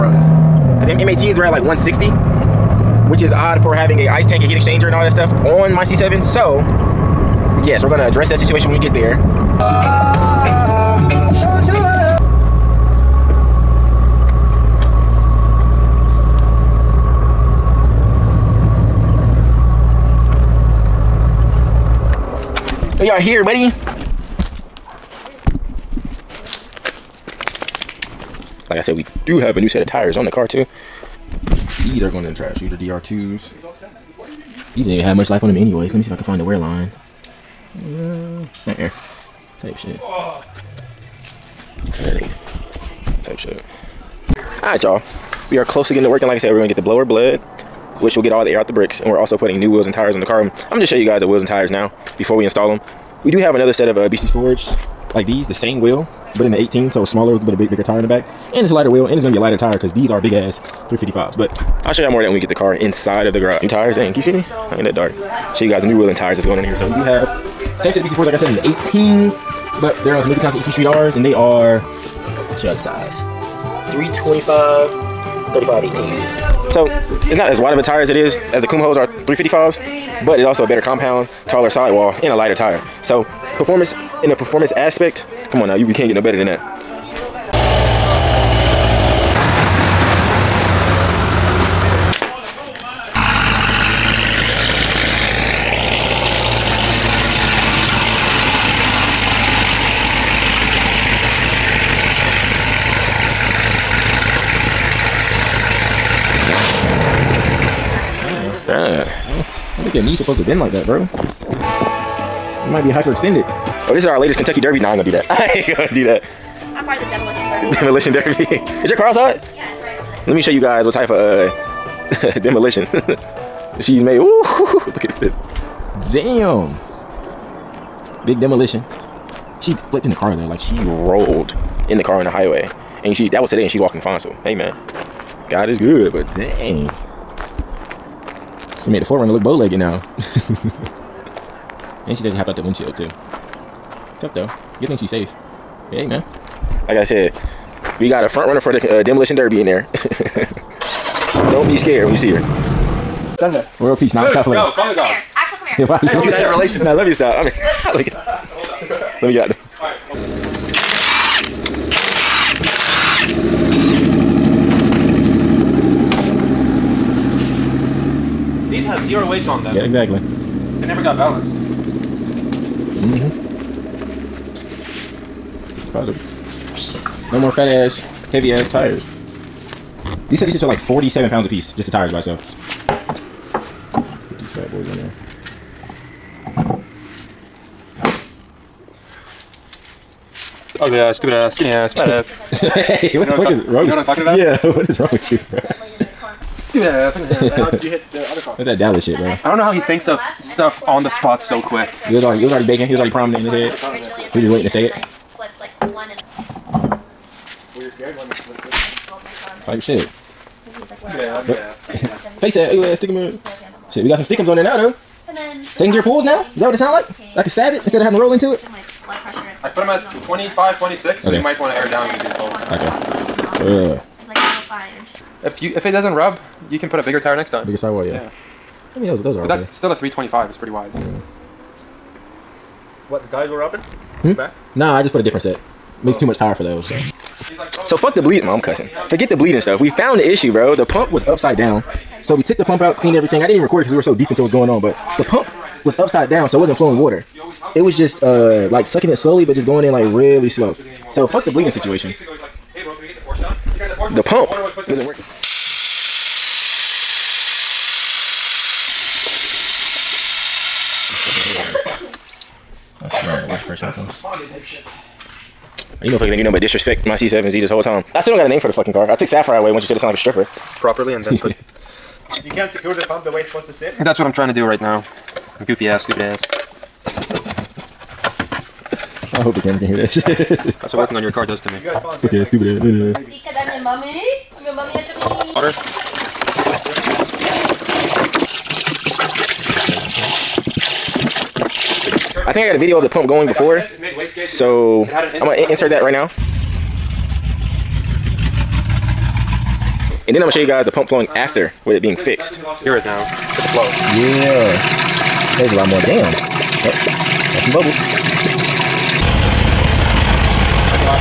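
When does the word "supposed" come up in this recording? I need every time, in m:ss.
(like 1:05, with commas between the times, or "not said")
1:50, 4:33.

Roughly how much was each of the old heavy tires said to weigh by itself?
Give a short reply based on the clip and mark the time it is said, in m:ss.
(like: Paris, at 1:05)
47 pounds, at 3:00.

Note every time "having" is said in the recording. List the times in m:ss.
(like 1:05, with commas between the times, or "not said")
0:03, 3:38.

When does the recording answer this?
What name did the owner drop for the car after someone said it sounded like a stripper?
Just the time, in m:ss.
4:29.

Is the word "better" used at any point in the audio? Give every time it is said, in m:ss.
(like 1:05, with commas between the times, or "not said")
1:20, 1:26.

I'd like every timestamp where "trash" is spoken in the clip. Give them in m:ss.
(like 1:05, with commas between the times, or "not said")
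0:32.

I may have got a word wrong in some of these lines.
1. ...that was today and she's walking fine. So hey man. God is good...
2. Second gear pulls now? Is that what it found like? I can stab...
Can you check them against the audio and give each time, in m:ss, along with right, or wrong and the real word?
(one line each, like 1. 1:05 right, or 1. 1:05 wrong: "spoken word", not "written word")
1. 2:13 right
2. 3:35 wrong: "sound", not "found".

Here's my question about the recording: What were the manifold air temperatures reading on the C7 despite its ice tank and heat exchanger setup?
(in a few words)
160.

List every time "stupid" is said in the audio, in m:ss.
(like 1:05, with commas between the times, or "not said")
3:11, 3:16, 4:36, 4:42.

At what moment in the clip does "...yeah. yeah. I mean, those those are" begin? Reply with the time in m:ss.
3:48.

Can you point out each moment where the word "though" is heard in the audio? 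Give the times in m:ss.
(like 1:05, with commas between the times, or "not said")
2:10, 2:24, 3:34.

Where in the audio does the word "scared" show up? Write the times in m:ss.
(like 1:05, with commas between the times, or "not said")
2:31.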